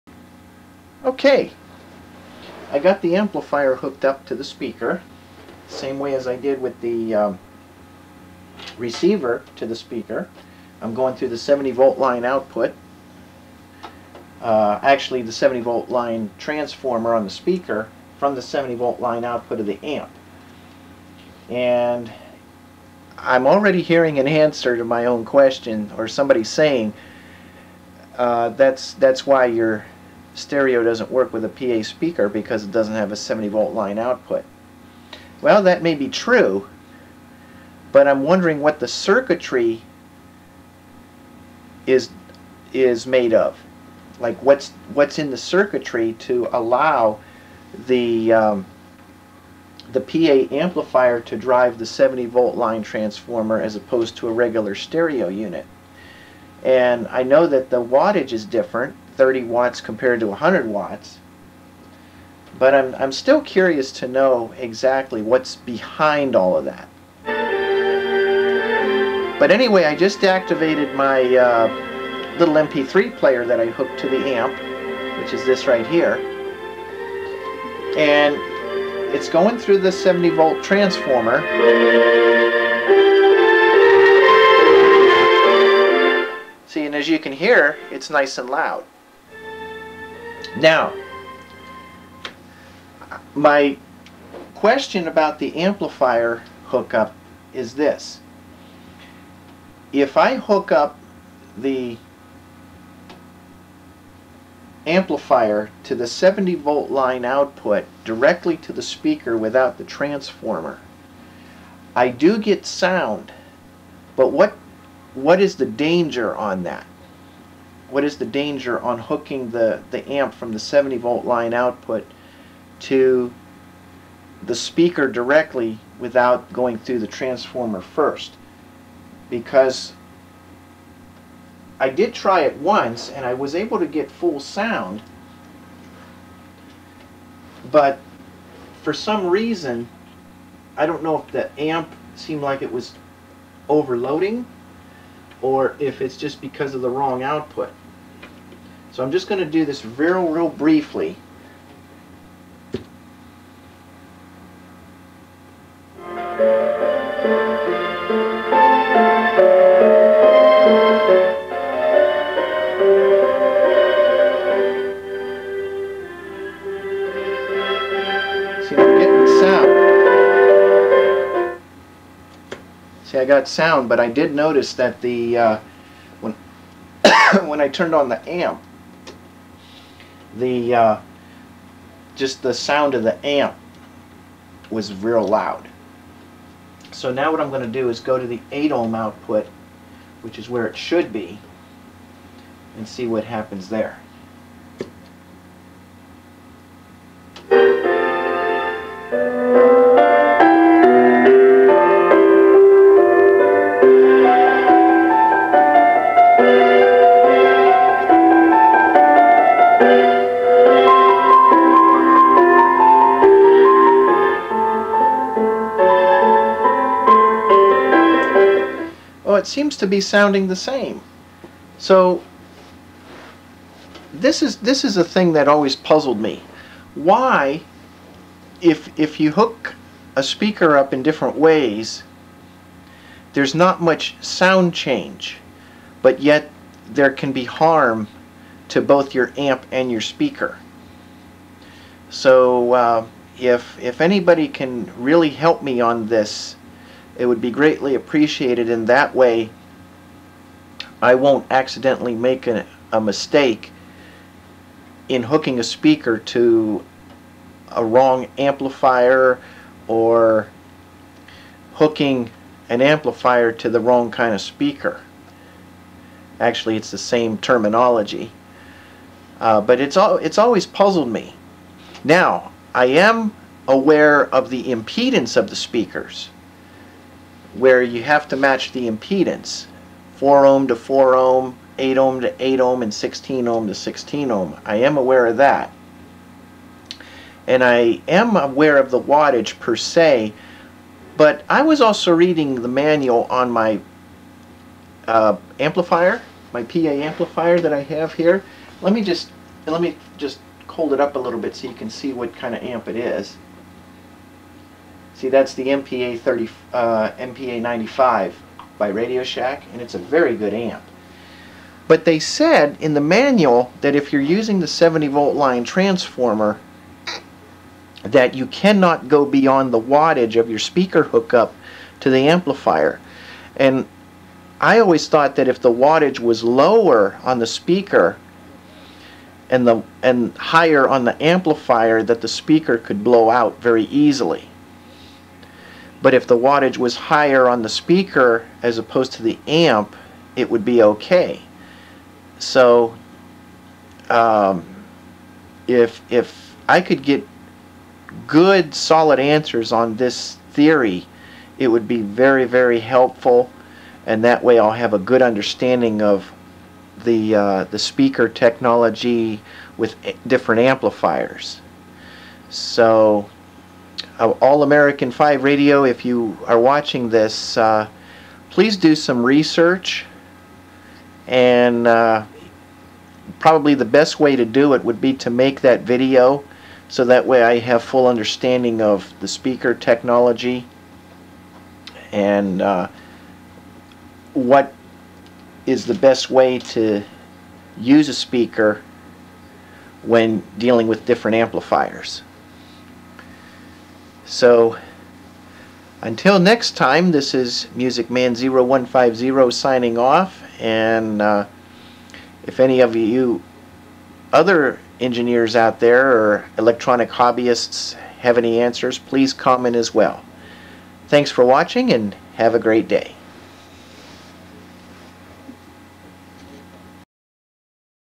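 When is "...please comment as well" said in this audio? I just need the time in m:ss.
6:48.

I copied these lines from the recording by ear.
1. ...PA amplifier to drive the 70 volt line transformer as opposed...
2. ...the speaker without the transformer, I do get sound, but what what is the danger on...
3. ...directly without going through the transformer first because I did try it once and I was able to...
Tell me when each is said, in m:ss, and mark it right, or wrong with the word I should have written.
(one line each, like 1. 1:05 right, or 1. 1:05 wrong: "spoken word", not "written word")
1. 0:50 right
2. 1:48 right
3. 2:05 right.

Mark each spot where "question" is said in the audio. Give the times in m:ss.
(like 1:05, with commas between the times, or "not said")
0:25, 1:34.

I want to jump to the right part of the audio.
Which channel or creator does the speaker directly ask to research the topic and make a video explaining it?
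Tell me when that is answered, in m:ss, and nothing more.
6:04.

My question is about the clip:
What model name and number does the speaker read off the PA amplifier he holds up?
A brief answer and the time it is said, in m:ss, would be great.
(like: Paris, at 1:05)
MPA 95, at 5:07.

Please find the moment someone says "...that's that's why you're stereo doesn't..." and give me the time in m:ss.
0:28.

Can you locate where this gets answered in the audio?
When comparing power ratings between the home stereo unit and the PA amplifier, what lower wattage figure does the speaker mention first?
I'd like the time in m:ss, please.
0:59.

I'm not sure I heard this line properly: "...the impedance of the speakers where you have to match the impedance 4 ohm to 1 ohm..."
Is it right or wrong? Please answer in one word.
wrong.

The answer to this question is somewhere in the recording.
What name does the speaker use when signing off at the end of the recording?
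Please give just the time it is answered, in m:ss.
6:37.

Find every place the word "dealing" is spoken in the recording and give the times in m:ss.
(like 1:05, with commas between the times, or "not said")
6:30.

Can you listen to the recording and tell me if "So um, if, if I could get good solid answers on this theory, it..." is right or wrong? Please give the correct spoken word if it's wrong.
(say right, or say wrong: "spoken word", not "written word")
right.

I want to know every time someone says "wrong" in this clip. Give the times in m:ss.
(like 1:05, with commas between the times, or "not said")
2:26, 4:17, 4:23.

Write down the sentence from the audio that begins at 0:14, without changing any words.
Uh, actually, the 70 volt line transformer on the speaker from the 70 volt line output of the amp.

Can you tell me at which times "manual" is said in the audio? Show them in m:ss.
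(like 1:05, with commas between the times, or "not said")
4:52, 5:13.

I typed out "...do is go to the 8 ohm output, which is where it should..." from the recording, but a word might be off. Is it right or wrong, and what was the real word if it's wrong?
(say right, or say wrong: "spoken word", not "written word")
right.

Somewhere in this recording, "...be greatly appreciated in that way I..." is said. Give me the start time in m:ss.
4:07.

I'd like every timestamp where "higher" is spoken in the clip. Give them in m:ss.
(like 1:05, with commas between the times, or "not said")
5:30, 5:36.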